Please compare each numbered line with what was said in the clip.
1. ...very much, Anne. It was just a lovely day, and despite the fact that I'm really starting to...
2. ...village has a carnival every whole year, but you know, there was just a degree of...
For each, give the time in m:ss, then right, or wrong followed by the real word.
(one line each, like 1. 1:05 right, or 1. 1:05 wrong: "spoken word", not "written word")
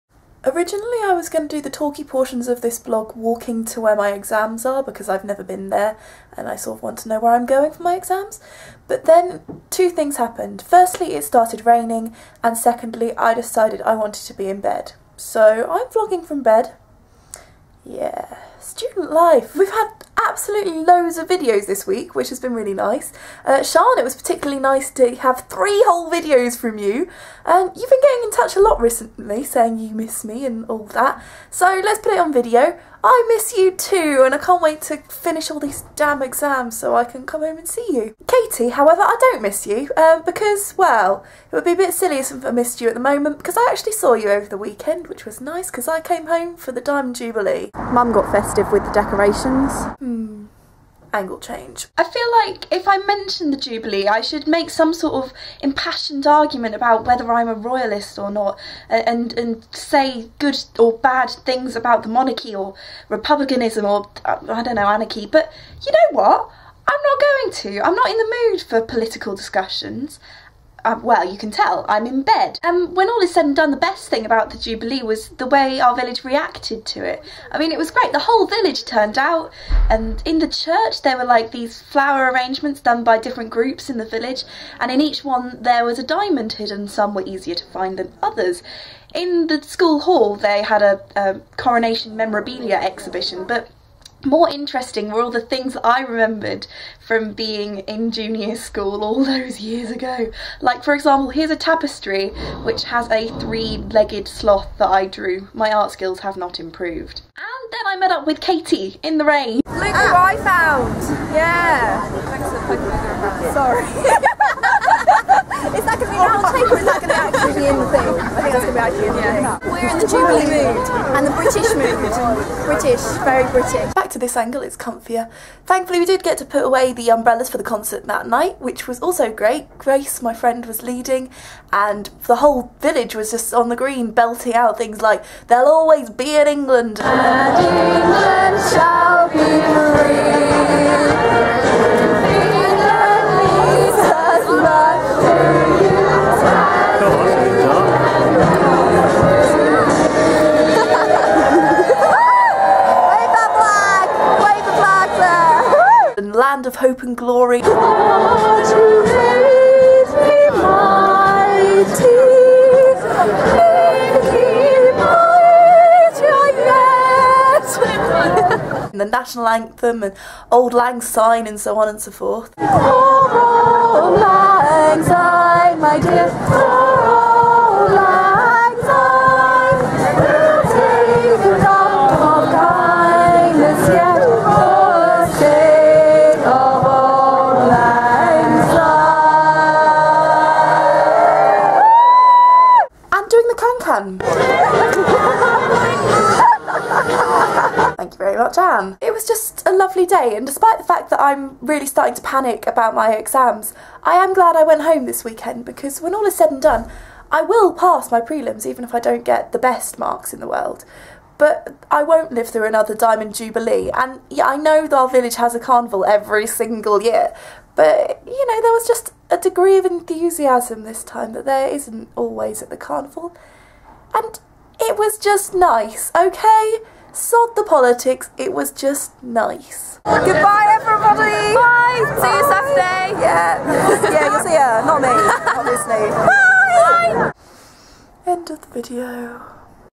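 1. 3:18 right
2. 3:35 wrong: "single", not "whole".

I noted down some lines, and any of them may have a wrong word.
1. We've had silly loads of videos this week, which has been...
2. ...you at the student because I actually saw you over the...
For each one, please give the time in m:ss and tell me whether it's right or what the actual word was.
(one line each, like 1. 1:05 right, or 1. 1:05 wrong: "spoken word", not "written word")
1. 0:19 wrong: "absolutely", not "silly"
2. 0:42 wrong: "moment", not "student".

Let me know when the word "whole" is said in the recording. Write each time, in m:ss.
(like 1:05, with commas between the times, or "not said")
0:25, 1:18, 2:12.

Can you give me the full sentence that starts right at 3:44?
And it was just nice, okay?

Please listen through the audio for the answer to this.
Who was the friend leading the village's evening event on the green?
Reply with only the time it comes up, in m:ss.
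2:09.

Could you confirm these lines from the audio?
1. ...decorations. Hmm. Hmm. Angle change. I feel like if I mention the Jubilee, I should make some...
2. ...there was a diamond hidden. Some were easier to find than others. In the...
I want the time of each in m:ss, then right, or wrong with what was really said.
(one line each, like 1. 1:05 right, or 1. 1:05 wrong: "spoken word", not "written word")
1. 0:48 right
2. 1:25 right.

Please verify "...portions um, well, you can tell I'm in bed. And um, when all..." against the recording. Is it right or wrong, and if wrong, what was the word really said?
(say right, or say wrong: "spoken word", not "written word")
wrong: "discussions", not "portions".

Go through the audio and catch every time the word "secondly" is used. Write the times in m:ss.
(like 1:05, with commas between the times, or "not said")
0:12.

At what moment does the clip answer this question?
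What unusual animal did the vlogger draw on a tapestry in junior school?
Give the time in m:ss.
1:43.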